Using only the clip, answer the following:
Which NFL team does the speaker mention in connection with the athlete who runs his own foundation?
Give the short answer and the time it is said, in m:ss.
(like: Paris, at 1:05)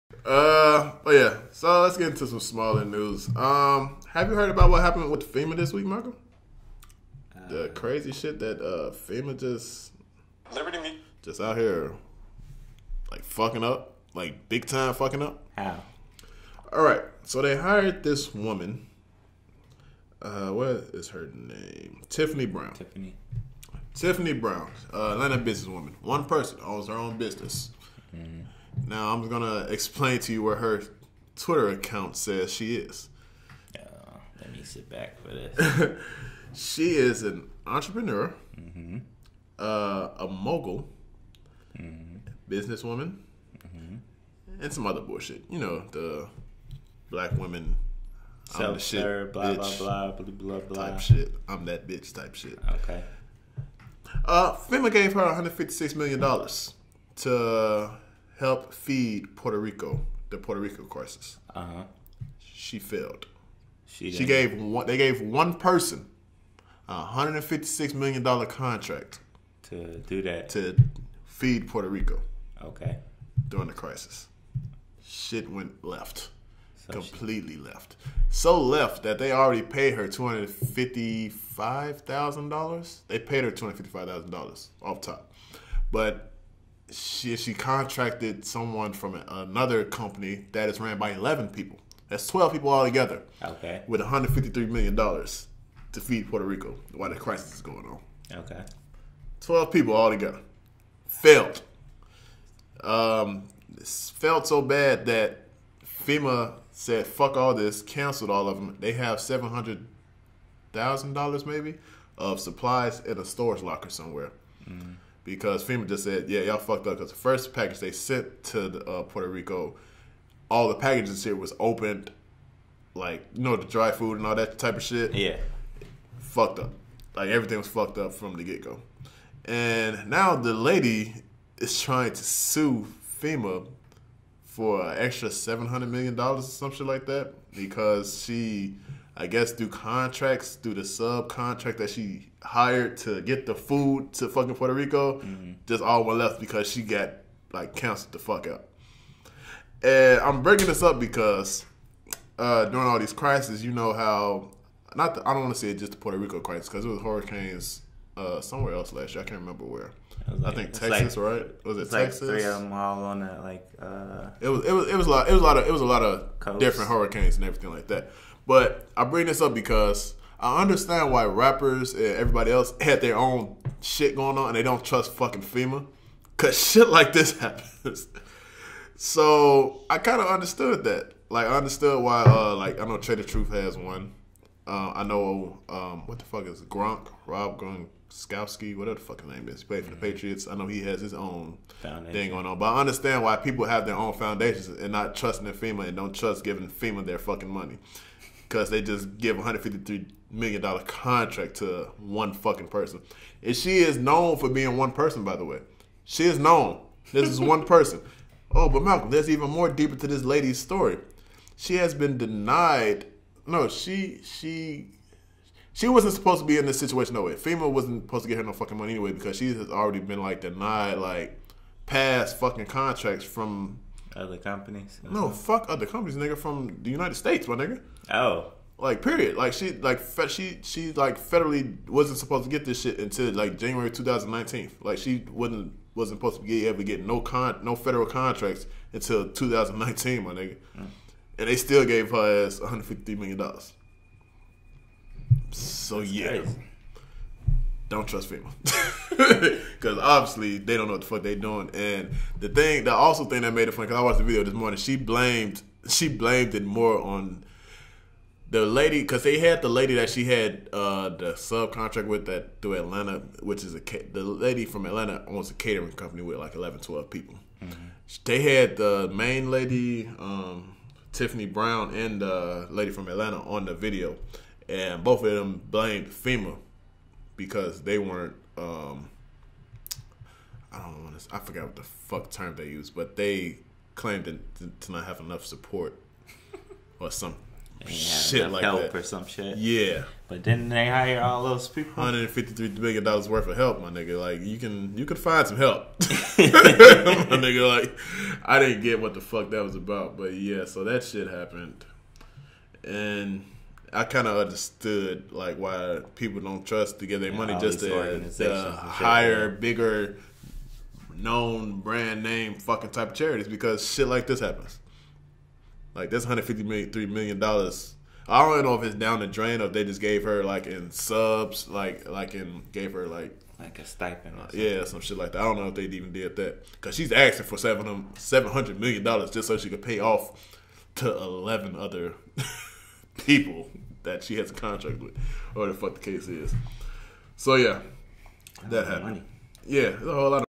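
Patriots, at 3:10.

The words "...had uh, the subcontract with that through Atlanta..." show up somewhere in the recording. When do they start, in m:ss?
4:20.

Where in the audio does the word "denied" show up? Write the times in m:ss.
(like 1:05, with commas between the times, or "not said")
3:32, 3:40.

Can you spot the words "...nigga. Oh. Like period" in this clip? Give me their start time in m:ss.
3:47.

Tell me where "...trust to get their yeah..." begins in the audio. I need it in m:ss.
5:06.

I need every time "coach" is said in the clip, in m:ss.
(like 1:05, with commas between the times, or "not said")
not said.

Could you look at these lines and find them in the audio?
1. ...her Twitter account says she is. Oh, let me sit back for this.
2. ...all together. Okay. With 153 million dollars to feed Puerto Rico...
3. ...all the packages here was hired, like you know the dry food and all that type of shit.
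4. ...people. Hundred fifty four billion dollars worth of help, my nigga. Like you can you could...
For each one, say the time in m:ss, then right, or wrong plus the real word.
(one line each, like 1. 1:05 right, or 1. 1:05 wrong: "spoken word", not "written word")
1. 0:30 right
2. 1:32 right
3. 2:00 wrong: "opened", not "hired"
4. 4:51 wrong: "three", not "four".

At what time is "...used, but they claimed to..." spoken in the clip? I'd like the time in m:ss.
4:42.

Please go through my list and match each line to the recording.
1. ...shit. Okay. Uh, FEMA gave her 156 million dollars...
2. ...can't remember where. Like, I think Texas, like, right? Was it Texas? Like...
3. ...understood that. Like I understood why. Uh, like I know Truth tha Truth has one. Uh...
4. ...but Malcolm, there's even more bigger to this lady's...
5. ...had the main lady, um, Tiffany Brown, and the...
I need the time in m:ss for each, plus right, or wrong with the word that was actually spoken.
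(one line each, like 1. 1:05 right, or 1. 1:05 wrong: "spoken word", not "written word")
1. 0:52 right
2. 2:39 right
3. 3:00 wrong: "Trae", not "Truth"
4. 3:28 wrong: "deeper", not "bigger"
5. 4:28 right.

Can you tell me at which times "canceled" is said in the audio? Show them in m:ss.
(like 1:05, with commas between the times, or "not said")
1:47, 2:27.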